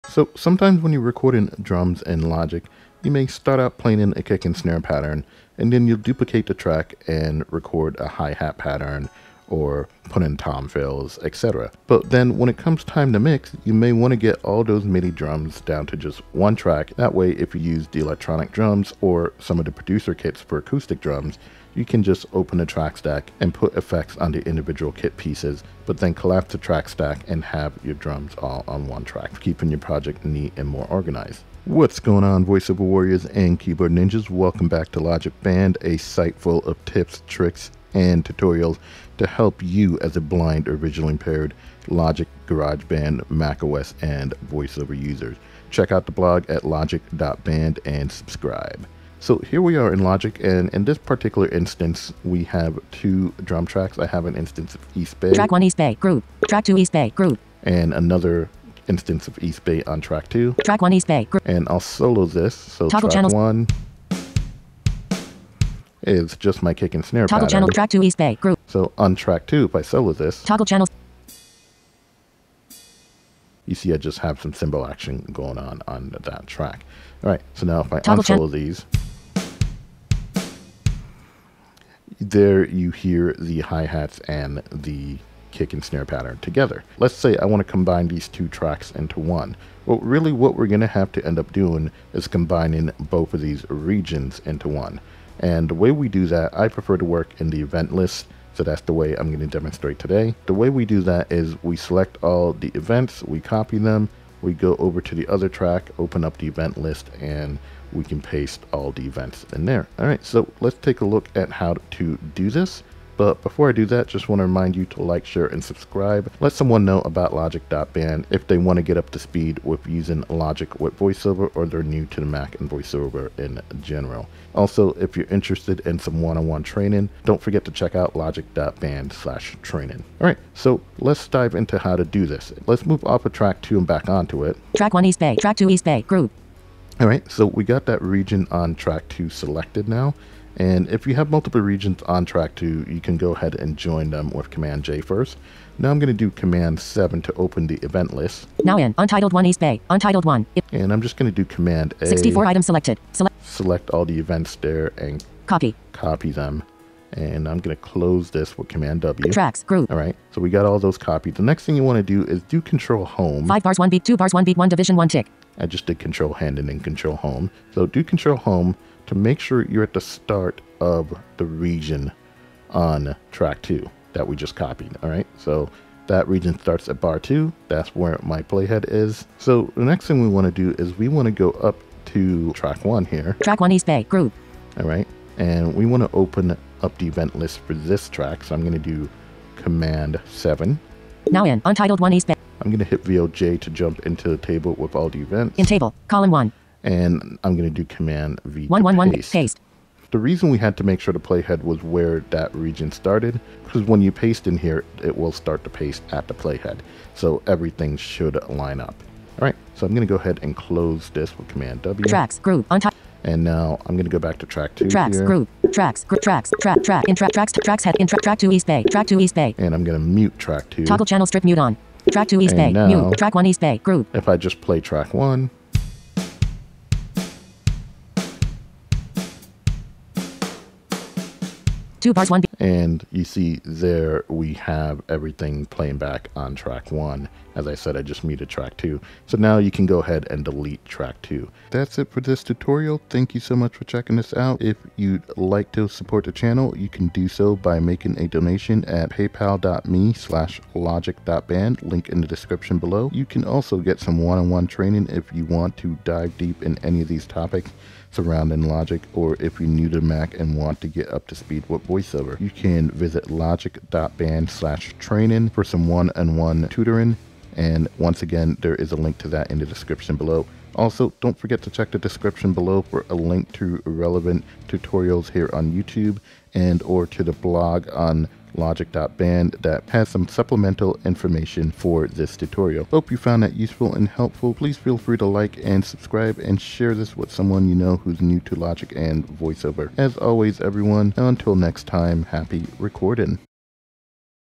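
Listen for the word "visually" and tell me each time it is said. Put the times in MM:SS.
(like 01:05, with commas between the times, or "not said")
00:40.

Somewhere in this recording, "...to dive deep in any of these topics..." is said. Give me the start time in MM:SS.
04:15.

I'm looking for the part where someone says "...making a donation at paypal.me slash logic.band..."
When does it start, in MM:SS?
04:07.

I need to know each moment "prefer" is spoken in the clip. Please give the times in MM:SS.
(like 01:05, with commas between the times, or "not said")
01:36.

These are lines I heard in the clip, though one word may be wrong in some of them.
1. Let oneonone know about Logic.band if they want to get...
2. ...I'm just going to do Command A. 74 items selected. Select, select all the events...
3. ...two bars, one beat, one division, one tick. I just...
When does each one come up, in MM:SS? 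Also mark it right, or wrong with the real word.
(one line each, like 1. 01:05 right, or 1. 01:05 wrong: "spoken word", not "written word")
1. 01:56 wrong: "someone", not "oneonone"
2. 02:30 wrong: "64", not "74"
3. 02:44 right.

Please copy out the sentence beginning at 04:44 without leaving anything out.
Please feel free to like and subscribe and share this with someone you know who's new to Logic and VoiceOver.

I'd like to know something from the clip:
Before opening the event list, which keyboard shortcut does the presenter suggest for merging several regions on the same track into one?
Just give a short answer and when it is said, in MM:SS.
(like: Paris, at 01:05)
Command J, at 02:24.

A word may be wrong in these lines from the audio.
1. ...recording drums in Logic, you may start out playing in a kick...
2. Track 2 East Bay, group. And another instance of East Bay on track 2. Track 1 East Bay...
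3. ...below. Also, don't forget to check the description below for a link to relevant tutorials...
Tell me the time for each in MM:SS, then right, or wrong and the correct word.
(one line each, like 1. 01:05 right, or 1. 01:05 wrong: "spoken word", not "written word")
1. 00:01 right
2. 00:56 right
3. 04:30 right.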